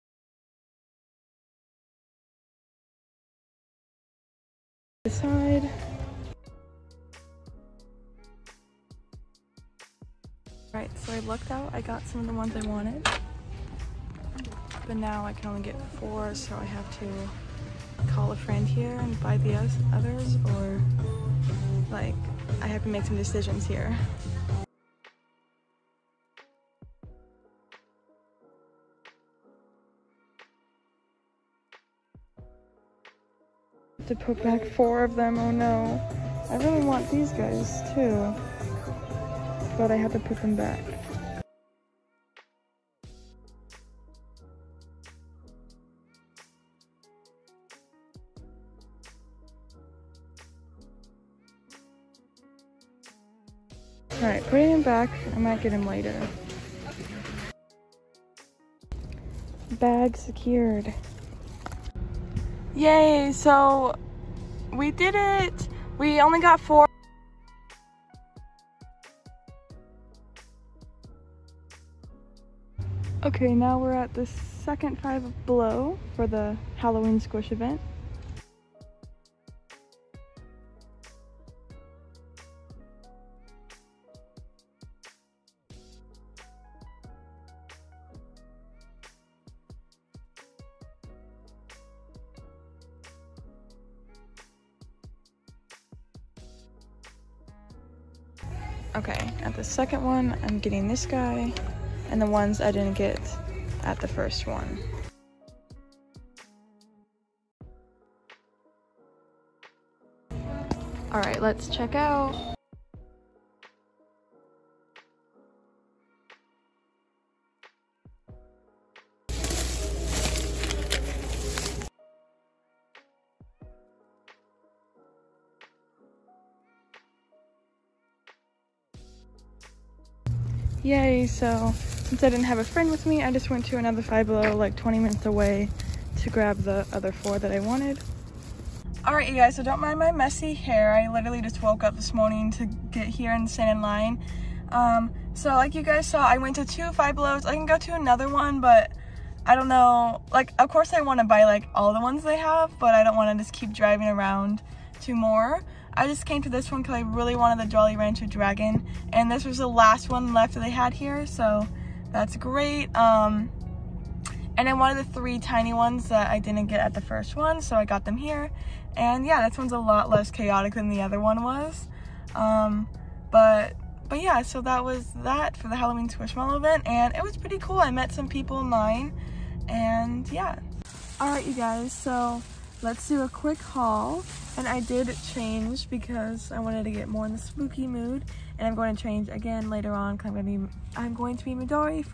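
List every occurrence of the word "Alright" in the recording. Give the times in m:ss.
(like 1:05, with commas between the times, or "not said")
0:54, 3:01.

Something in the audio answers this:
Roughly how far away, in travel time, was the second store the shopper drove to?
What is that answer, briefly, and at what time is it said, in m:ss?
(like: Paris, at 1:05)
20 minutes, at 2:14.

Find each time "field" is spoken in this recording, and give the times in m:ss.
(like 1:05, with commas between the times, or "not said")
not said.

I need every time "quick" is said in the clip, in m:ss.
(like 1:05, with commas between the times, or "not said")
3:03.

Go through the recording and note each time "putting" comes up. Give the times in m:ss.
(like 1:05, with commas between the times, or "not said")
0:54.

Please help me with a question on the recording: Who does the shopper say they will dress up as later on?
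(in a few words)
Midori.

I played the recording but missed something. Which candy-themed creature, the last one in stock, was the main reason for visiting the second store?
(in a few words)
Jolly Rancher Dragon.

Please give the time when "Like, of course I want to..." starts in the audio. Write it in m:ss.
2:30.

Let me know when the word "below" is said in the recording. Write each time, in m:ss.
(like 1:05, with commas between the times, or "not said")
1:15, 2:14, 2:27.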